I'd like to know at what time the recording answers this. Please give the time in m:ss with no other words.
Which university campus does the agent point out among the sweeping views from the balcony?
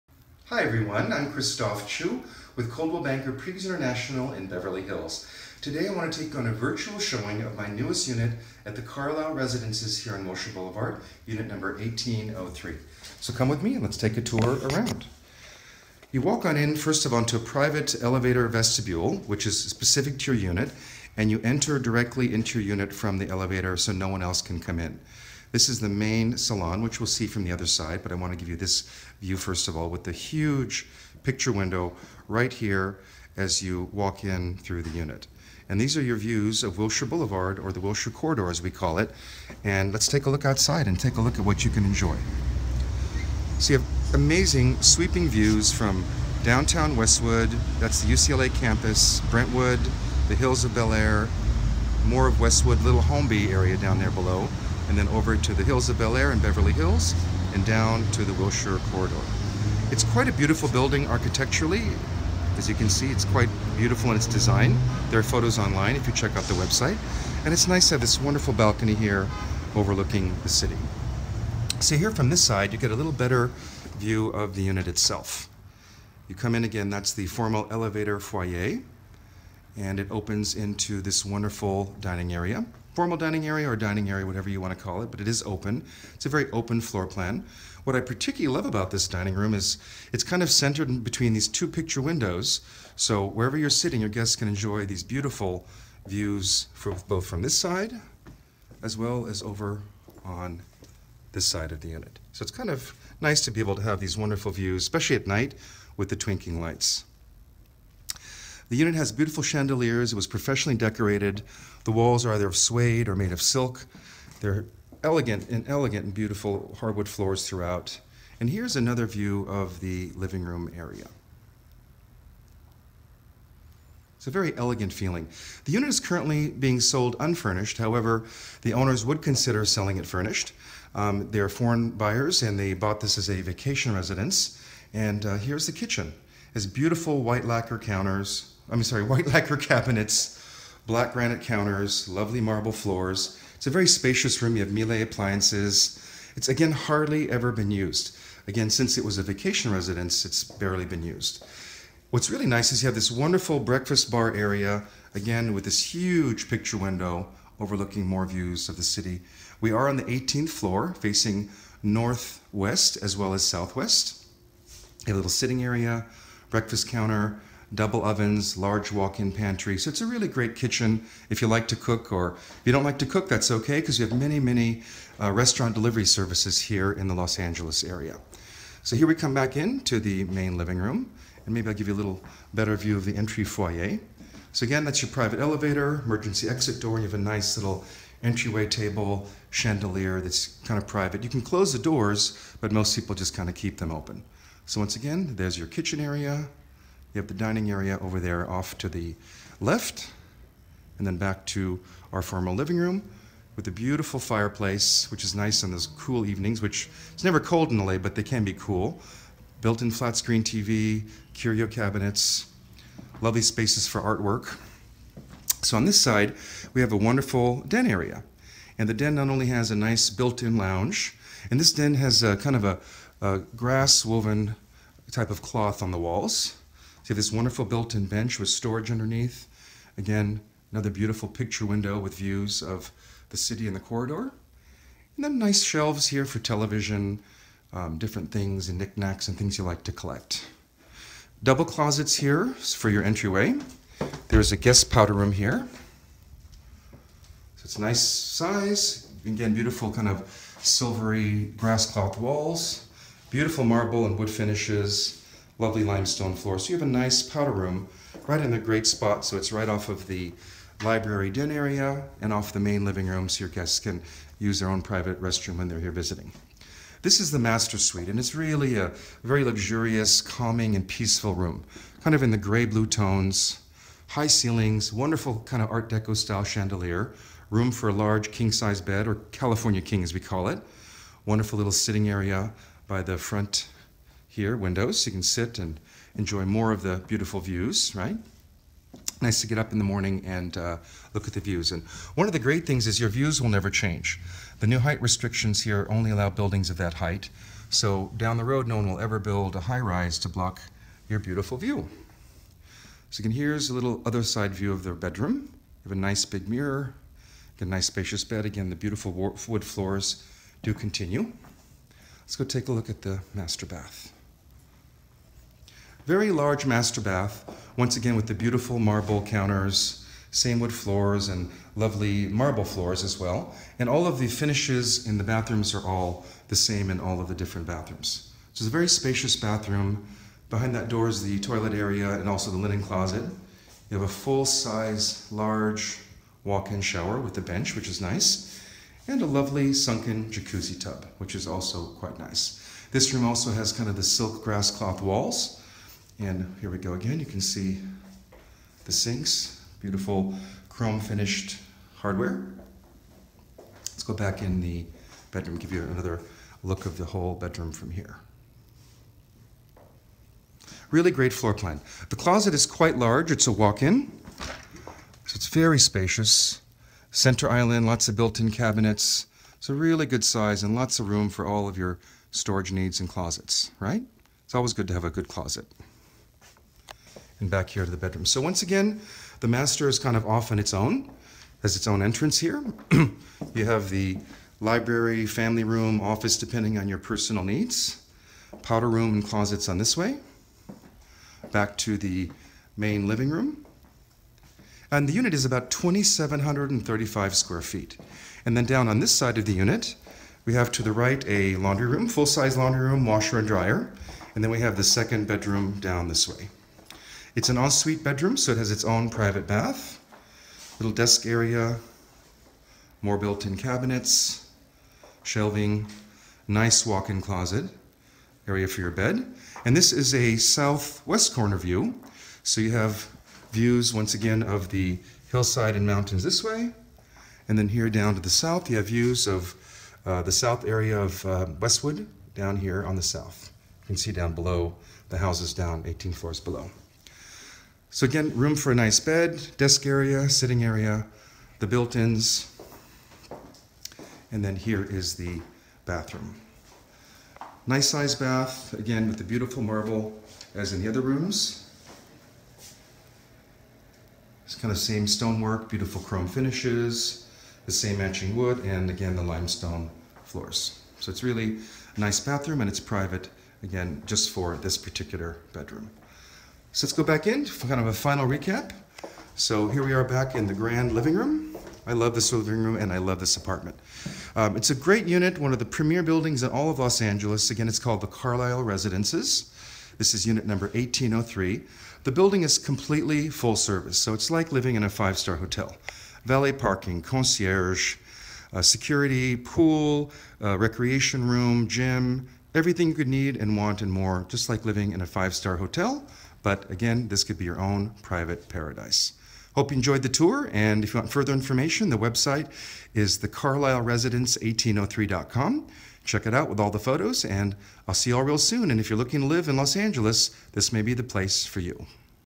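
0:48.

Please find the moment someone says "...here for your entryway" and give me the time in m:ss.
4:02.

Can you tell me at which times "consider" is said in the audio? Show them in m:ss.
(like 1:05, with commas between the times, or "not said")
2:09.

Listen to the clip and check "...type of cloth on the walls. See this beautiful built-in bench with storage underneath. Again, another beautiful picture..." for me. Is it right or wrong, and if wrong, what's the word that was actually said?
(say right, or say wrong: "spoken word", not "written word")
wrong: "wonderful", not "beautiful".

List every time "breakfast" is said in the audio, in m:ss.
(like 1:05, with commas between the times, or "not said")
2:33, 2:46.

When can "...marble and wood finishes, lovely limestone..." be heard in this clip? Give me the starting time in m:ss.
4:13.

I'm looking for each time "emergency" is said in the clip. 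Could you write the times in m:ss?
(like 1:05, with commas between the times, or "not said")
3:06.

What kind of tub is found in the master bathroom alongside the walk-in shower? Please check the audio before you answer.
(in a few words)
sunken jacuzzi tub.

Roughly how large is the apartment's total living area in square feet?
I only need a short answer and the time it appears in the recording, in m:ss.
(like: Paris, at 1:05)
2,735 square feet, at 6:35.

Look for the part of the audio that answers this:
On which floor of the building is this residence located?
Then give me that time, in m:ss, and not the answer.
2:40.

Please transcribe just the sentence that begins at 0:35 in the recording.
And these are your views of Wilshire Boulevard, or the Wilshire Corridor as we call it.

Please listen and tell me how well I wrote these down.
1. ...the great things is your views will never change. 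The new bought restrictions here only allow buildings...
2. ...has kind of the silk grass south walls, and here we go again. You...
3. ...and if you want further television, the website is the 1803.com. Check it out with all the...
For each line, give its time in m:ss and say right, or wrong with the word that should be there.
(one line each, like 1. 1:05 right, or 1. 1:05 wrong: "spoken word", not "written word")
1. 4:52 wrong: "height", not "bought"
2. 5:43 wrong: "cloth", not "south"
3. 8:20 wrong: "information", not "television".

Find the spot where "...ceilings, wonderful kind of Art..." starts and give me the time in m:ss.
4:34.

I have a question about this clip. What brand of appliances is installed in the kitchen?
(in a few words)
Miele.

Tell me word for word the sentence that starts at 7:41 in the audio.
So it's really a nice bathroom and it's private, again, just for this particular bedroom.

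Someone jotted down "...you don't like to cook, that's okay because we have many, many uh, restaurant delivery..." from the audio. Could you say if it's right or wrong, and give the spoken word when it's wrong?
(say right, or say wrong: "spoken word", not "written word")
right.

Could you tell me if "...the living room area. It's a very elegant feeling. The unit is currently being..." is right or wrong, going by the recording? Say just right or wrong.
right.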